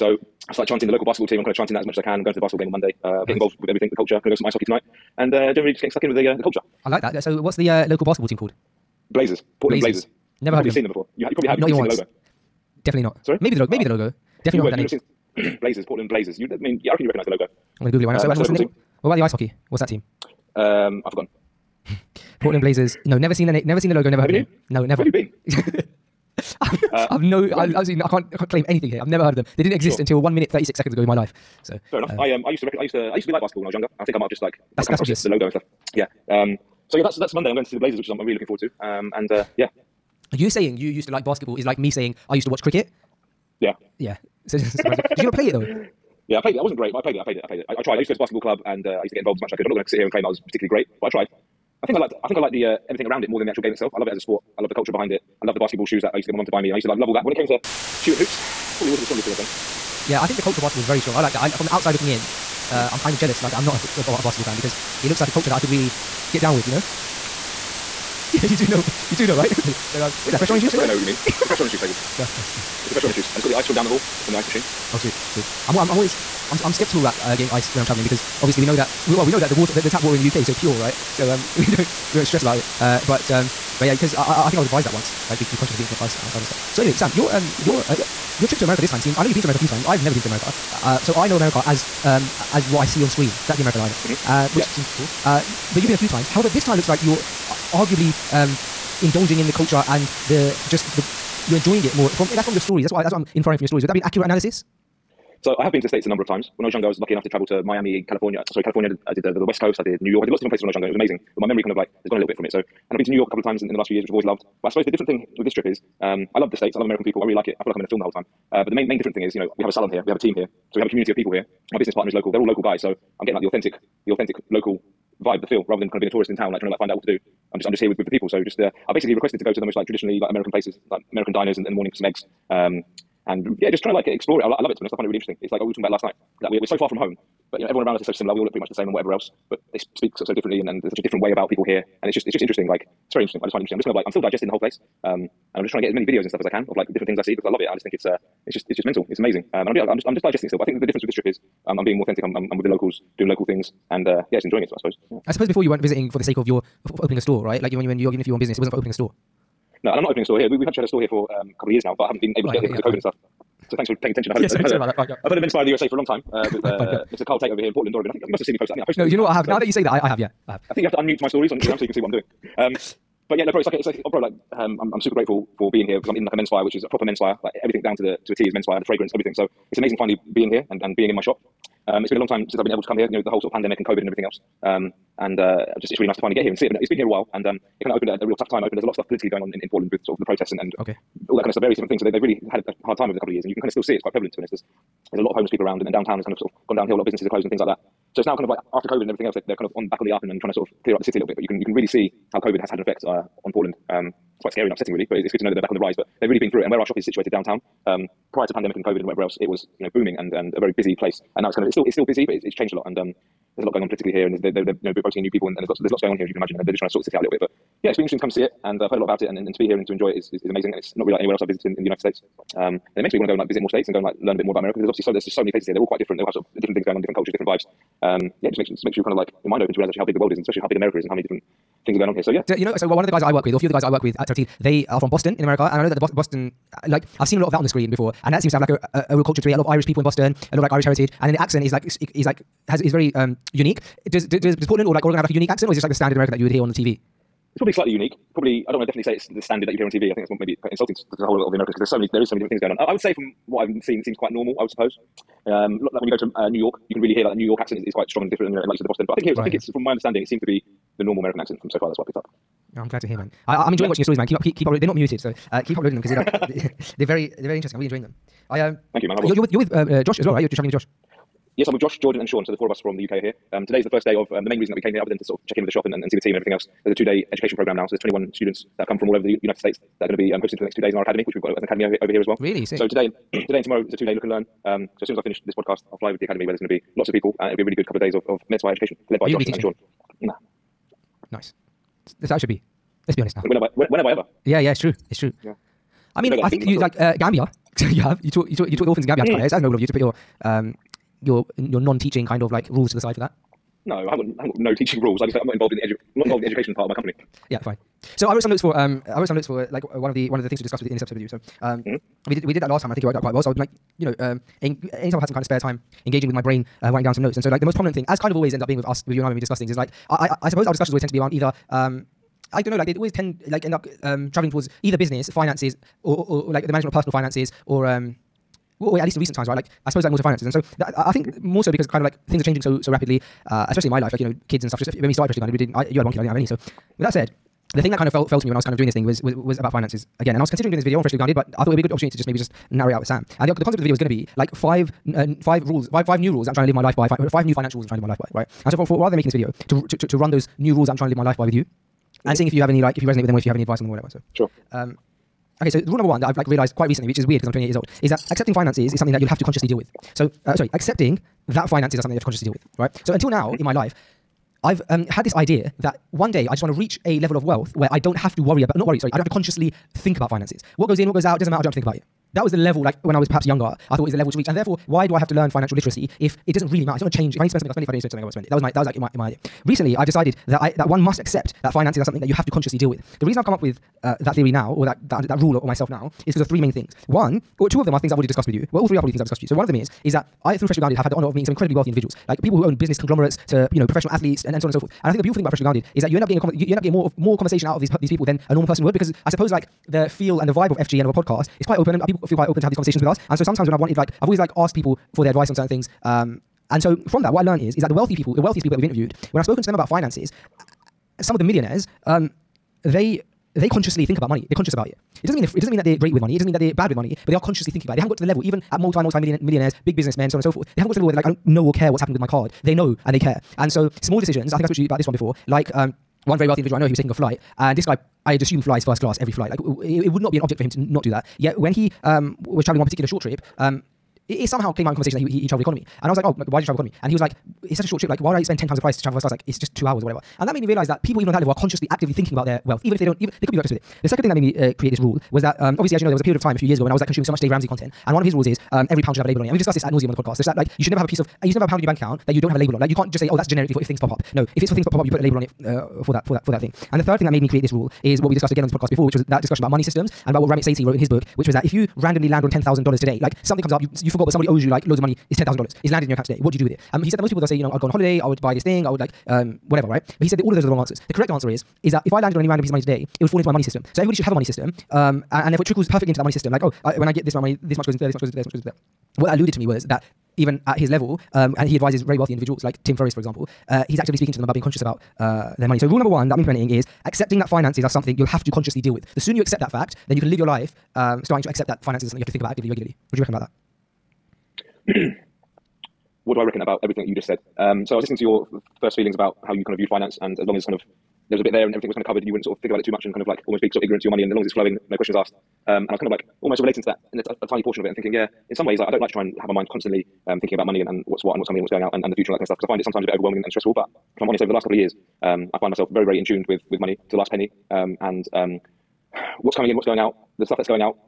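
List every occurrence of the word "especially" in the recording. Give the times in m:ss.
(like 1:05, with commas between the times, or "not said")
3:50, 5:33.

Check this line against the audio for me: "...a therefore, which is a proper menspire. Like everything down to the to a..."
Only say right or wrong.
wrong.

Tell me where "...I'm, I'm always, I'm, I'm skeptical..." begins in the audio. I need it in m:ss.
1:15.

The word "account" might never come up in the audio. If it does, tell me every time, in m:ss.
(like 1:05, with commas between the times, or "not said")
7:31, 7:46.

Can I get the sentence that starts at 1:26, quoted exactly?
So anyway, Sam, your um your uh, yeah.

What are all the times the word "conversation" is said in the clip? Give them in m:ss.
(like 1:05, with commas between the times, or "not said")
6:37, 6:42, 7:14.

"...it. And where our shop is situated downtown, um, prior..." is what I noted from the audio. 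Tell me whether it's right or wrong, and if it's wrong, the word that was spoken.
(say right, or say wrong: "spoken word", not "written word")
right.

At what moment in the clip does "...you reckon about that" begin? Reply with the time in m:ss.
8:13.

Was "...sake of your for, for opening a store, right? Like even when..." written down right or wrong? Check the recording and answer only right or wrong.
right.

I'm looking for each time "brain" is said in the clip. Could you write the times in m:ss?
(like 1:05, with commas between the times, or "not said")
5:16.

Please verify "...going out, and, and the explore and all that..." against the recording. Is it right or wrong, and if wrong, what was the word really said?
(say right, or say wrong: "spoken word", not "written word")
wrong: "future", not "explore".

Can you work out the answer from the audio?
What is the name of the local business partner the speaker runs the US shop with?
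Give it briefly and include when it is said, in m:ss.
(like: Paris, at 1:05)
Carl Tate, at 2:47.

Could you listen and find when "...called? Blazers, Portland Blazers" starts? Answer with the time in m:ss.
0:08.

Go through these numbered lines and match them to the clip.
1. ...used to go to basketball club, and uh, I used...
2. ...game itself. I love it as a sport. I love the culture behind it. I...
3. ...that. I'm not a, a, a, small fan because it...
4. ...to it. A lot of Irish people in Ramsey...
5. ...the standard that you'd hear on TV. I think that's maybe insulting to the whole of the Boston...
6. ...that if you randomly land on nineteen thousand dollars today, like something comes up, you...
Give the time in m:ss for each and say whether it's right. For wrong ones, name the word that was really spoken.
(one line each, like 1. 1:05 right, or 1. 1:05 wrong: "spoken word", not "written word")
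1. 0:47 right
2. 0:53 right
3. 1:03 wrong: "basketball", not "small"
4. 3:59 wrong: "Boston", not "Ramsey"
5. 4:09 wrong: "Americans", not "Boston"
6. 7:41 wrong: "ten", not "nineteen".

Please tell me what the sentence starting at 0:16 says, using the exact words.
You, I mean, yeah, I reckon you recognise the logo.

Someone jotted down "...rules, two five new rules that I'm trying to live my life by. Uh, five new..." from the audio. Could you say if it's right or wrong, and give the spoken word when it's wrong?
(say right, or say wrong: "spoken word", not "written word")
wrong: "five", not "two".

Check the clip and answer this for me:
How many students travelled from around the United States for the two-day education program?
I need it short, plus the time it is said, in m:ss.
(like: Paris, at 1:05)
21, at 4:37.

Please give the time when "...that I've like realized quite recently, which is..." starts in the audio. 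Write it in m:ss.
5:56.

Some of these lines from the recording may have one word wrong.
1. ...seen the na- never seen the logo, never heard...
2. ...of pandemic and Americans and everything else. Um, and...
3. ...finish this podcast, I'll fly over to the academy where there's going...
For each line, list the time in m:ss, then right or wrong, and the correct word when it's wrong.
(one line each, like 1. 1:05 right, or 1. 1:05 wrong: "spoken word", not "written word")
1. 0:23 right
2. 3:03 wrong: "COVID", not "Americans"
3. 4:45 right.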